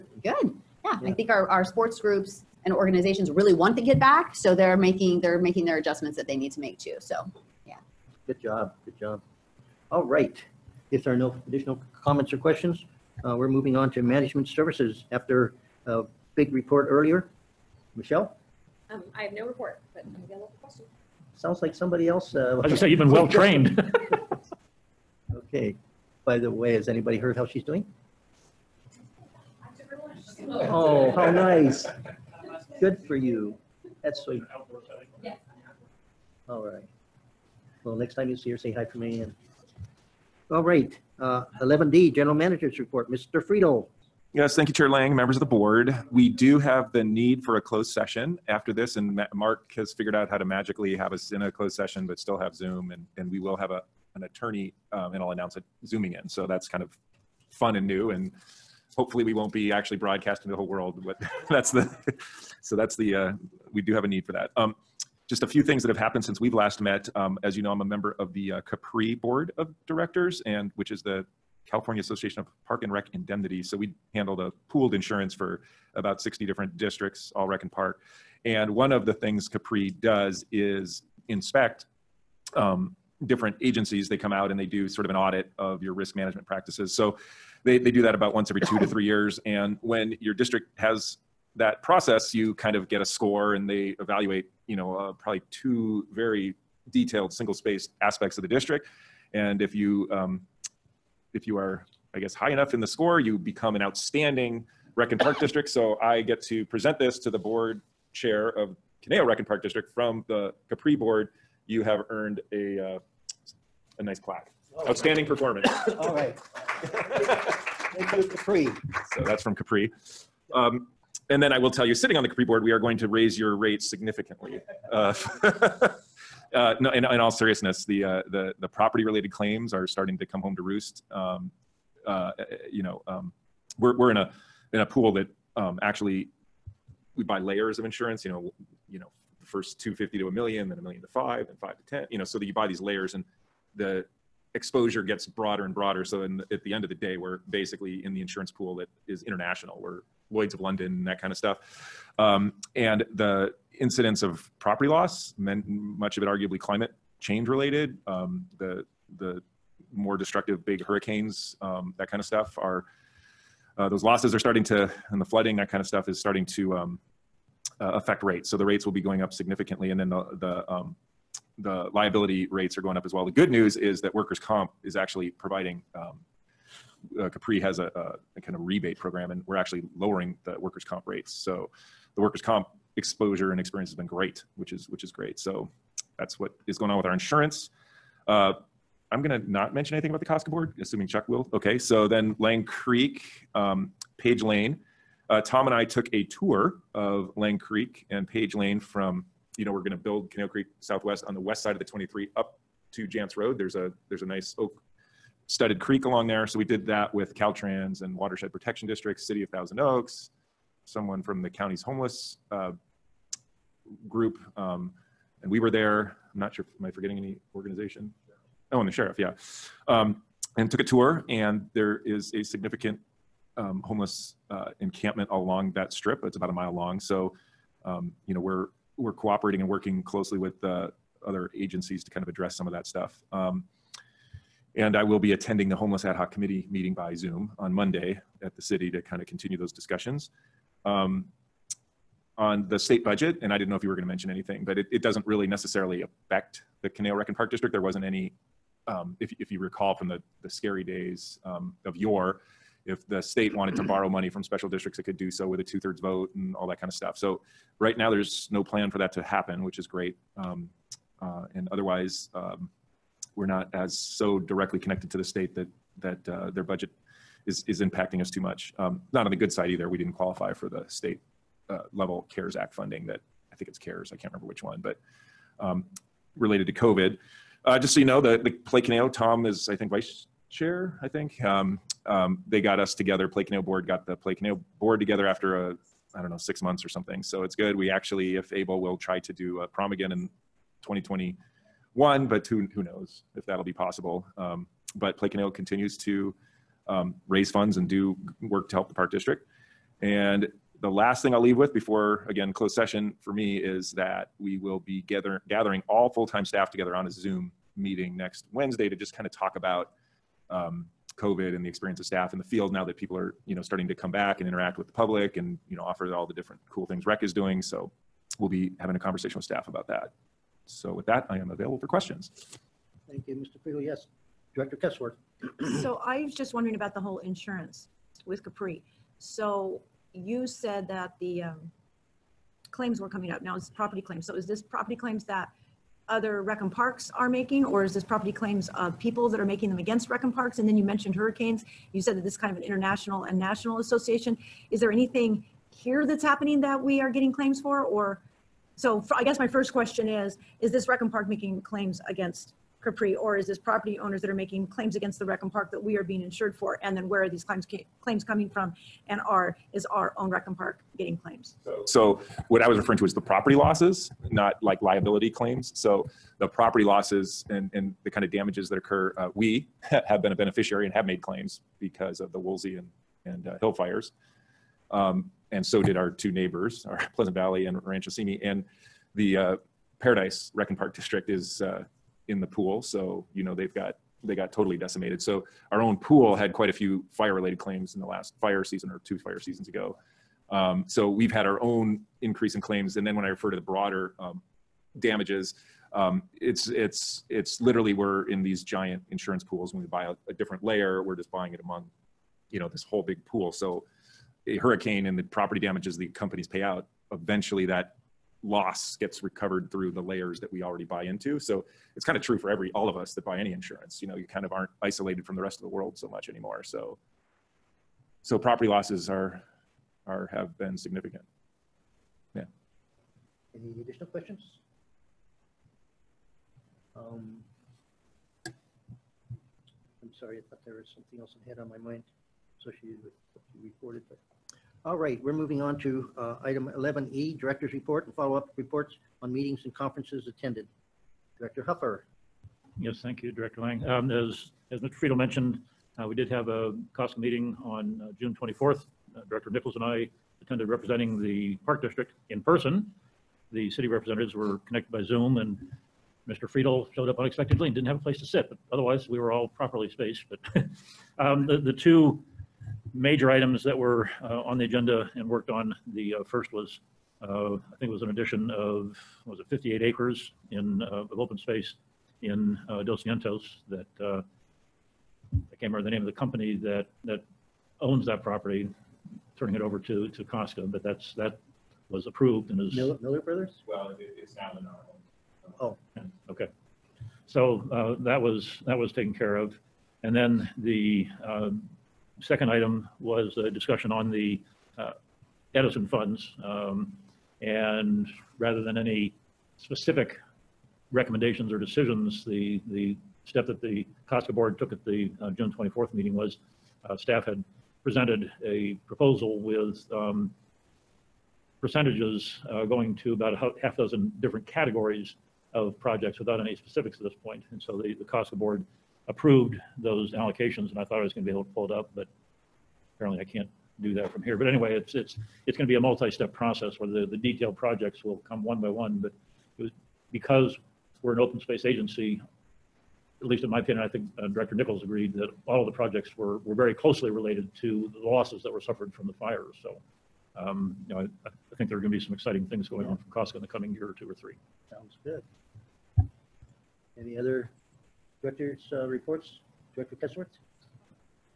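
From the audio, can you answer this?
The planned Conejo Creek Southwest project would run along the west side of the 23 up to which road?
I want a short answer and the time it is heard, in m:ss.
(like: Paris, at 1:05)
Janss Road, at 3:23.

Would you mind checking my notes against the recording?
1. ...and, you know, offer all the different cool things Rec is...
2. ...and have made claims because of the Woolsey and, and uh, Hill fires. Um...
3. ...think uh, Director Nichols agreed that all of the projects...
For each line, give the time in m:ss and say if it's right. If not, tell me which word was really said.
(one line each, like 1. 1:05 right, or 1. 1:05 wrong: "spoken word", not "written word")
1. 5:15 right
2. 6:10 right
3. 8:53 right.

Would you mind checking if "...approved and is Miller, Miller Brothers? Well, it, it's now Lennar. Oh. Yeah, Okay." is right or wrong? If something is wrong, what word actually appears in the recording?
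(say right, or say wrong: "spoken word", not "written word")
right.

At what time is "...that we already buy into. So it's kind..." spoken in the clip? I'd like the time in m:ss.
6:50.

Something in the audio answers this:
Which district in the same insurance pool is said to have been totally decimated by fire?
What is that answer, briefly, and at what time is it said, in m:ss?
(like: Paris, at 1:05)
Paradise Rec Park District, at 6:19.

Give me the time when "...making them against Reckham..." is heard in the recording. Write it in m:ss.
5:39.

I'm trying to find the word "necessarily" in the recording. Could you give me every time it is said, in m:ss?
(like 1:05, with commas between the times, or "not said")
4:05.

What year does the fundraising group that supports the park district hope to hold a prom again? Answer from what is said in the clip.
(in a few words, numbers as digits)
2021.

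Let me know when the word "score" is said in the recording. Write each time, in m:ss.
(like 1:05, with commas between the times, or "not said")
1:33, 1:42.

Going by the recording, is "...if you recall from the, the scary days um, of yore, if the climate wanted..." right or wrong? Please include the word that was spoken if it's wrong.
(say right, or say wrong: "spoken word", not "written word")
wrong: "state", not "climate".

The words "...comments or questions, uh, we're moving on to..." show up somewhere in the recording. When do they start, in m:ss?
0:11.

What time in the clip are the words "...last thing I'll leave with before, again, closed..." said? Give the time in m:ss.
5:00.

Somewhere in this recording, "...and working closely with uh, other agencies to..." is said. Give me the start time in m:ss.
3:49.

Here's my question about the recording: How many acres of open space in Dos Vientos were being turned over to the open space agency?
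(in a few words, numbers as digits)
58.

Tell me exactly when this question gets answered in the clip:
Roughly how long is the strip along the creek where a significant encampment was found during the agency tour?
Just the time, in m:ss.
3:46.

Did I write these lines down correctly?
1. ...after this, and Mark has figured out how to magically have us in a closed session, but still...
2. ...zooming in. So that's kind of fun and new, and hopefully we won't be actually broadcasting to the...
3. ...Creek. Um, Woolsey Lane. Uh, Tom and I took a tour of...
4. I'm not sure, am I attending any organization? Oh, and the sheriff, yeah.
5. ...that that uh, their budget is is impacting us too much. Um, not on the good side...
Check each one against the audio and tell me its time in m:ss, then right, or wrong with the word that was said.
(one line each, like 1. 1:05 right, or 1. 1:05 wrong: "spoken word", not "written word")
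1. 0:48 right
2. 0:55 right
3. 3:12 wrong: "Page", not "Woolsey"
4. 3:36 wrong: "forgetting", not "attending"
5. 4:25 right.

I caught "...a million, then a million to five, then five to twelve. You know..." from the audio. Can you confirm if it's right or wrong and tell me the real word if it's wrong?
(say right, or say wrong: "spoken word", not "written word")
wrong: "ten", not "twelve".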